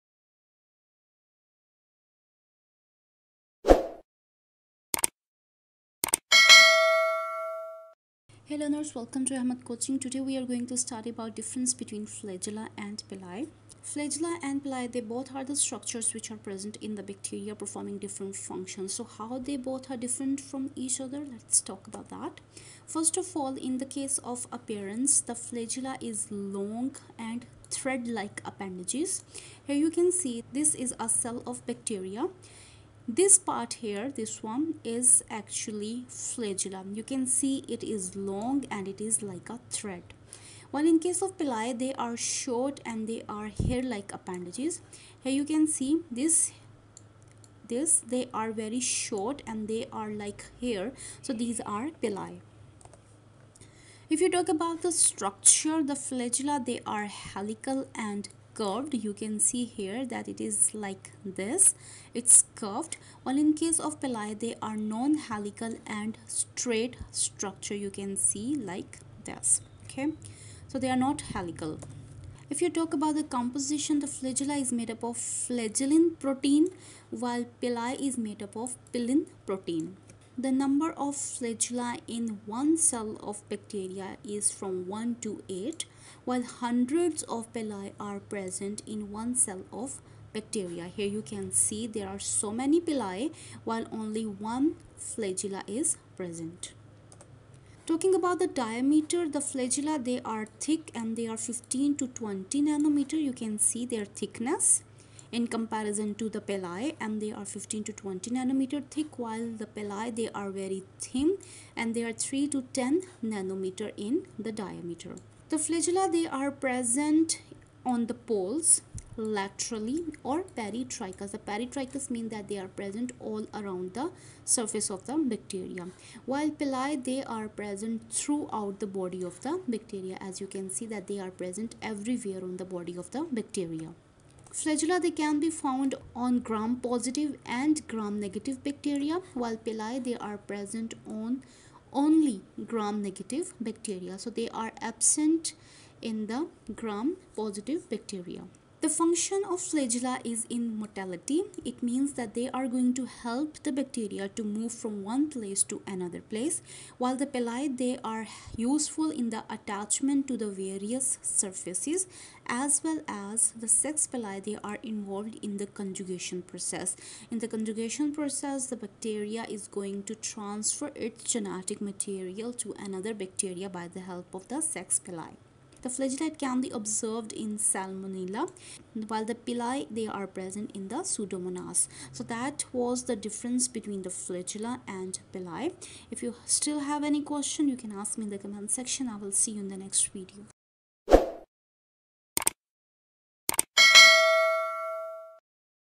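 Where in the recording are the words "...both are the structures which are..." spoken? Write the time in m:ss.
0:14.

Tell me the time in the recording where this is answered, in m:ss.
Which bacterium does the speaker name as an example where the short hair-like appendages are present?
3:01.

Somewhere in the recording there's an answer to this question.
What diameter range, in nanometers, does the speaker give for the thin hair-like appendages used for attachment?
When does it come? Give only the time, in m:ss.
1:52.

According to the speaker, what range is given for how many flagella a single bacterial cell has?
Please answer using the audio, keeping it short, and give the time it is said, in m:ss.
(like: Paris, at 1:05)
1 to 8, at 1:24.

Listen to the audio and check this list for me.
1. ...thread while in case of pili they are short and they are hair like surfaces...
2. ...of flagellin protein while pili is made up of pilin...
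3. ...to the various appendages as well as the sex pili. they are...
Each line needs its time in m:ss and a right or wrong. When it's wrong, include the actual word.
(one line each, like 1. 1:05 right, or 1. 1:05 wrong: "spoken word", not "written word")
1. 0:39 wrong: "appendages", not "surfaces"
2. 1:15 right
3. 2:40 wrong: "surfaces", not "appendages".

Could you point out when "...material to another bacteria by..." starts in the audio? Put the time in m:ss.
2:51.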